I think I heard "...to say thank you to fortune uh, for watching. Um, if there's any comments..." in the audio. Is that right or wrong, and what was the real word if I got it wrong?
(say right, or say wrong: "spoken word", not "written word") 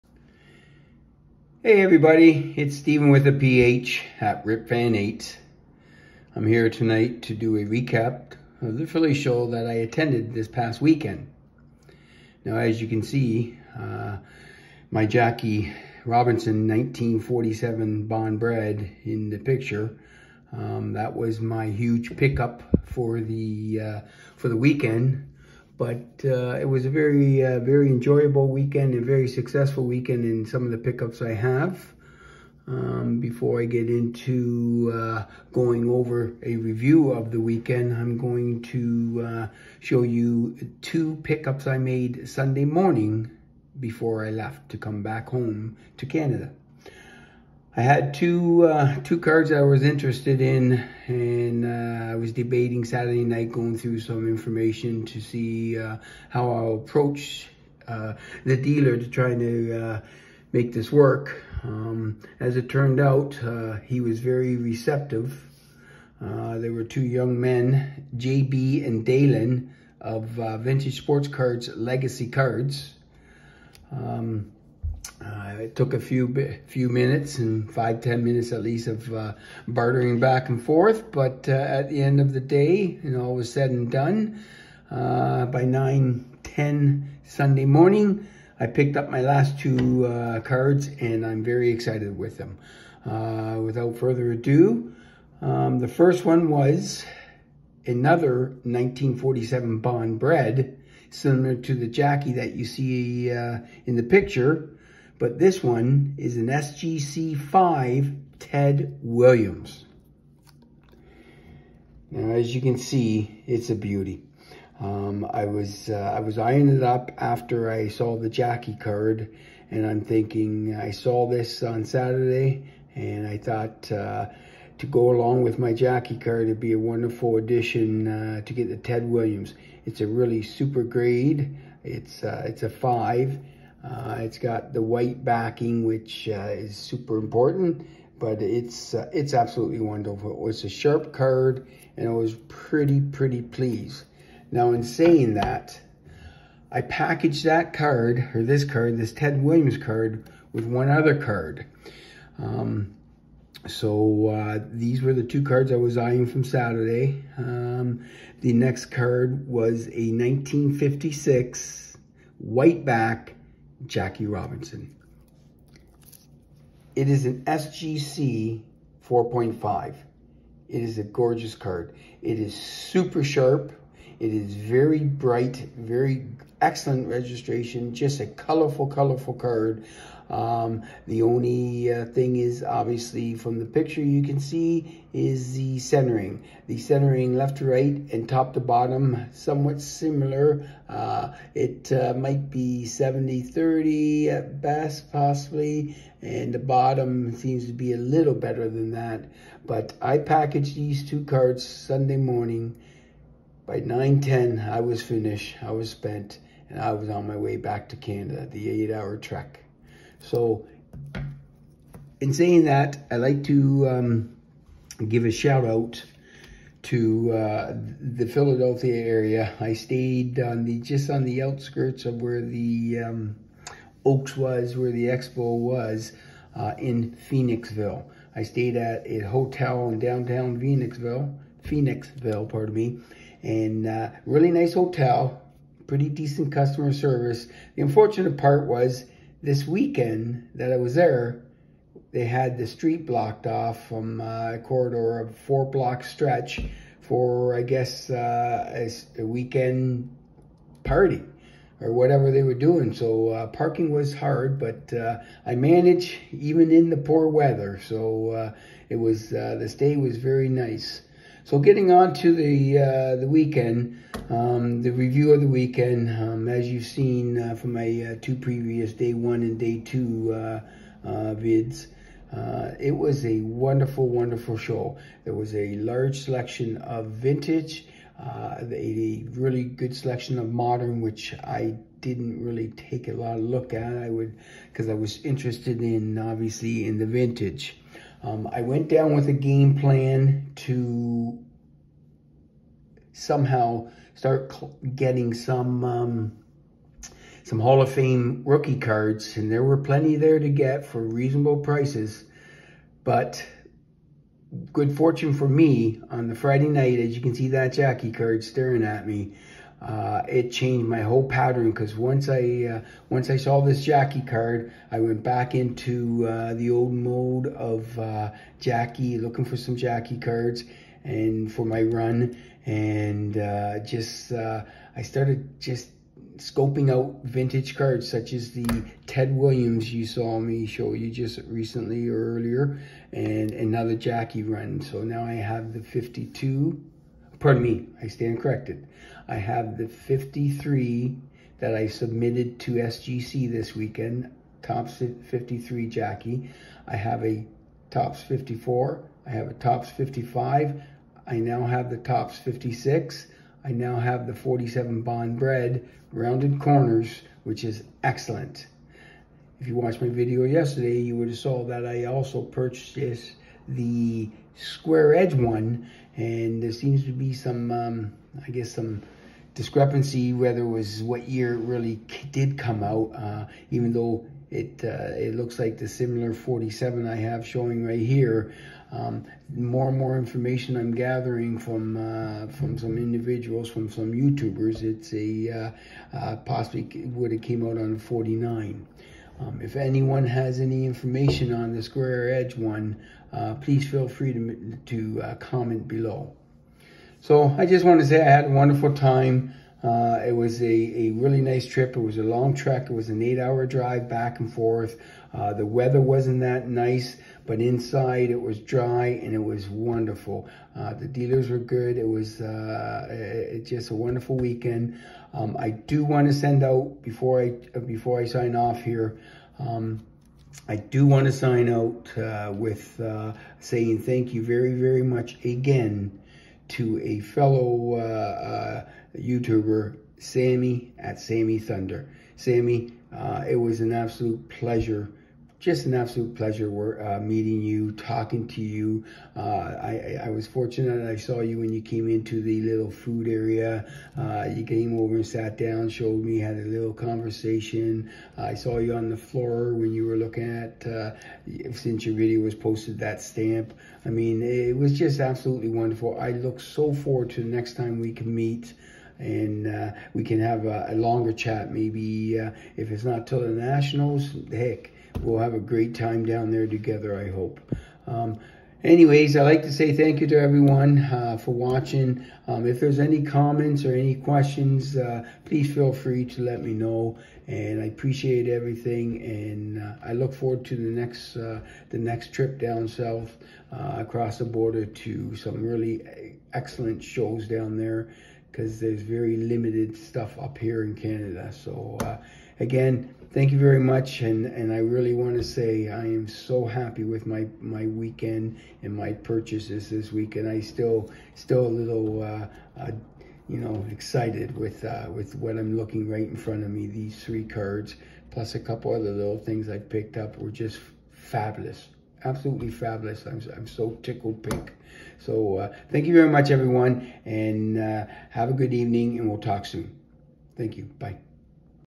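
wrong: "everyone", not "fortune".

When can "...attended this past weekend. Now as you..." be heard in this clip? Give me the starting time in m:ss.
0:09.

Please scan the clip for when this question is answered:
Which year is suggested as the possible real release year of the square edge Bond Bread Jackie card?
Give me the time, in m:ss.
6:27.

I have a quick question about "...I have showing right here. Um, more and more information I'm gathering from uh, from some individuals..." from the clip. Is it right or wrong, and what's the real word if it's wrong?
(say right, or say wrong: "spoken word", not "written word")
right.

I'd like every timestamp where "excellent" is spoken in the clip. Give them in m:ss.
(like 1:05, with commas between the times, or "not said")
2:56, 5:58, 8:06.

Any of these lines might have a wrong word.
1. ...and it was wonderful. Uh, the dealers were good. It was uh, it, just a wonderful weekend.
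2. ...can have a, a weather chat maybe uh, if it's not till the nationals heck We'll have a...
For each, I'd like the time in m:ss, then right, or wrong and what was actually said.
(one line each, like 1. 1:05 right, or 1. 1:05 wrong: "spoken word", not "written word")
1. 6:49 right
2. 7:40 wrong: "longer", not "weather".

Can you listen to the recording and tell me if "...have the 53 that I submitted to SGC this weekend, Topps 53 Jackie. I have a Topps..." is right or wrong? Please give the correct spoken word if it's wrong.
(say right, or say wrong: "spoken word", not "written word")
right.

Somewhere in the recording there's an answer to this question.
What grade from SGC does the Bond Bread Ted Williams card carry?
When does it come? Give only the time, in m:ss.
1:46.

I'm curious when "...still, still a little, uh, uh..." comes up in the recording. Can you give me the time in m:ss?
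8:20.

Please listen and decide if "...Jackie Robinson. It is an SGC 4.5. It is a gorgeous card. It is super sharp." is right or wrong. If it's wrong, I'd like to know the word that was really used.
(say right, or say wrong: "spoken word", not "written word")
right.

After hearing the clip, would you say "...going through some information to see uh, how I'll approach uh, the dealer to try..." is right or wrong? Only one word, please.
right.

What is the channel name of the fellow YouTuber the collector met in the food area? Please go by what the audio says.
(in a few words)
Sammy Thunder.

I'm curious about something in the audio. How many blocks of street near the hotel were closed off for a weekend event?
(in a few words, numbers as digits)
4.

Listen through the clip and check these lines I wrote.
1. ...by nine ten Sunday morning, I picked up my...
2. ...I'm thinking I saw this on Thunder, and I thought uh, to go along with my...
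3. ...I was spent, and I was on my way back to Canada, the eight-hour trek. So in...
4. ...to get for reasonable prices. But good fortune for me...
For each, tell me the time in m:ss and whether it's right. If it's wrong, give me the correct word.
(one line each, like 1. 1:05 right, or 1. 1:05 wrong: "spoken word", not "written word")
1. 1:25 right
2. 1:59 wrong: "Saturday", not "Thunder"
3. 3:25 right
4. 5:00 right.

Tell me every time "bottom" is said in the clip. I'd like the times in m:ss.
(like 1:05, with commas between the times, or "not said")
3:08, 3:16.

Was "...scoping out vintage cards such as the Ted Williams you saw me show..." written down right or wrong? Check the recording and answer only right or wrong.
right.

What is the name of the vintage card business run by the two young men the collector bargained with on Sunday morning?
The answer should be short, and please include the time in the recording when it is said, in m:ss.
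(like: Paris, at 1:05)
Legacy Cards, at 1:11.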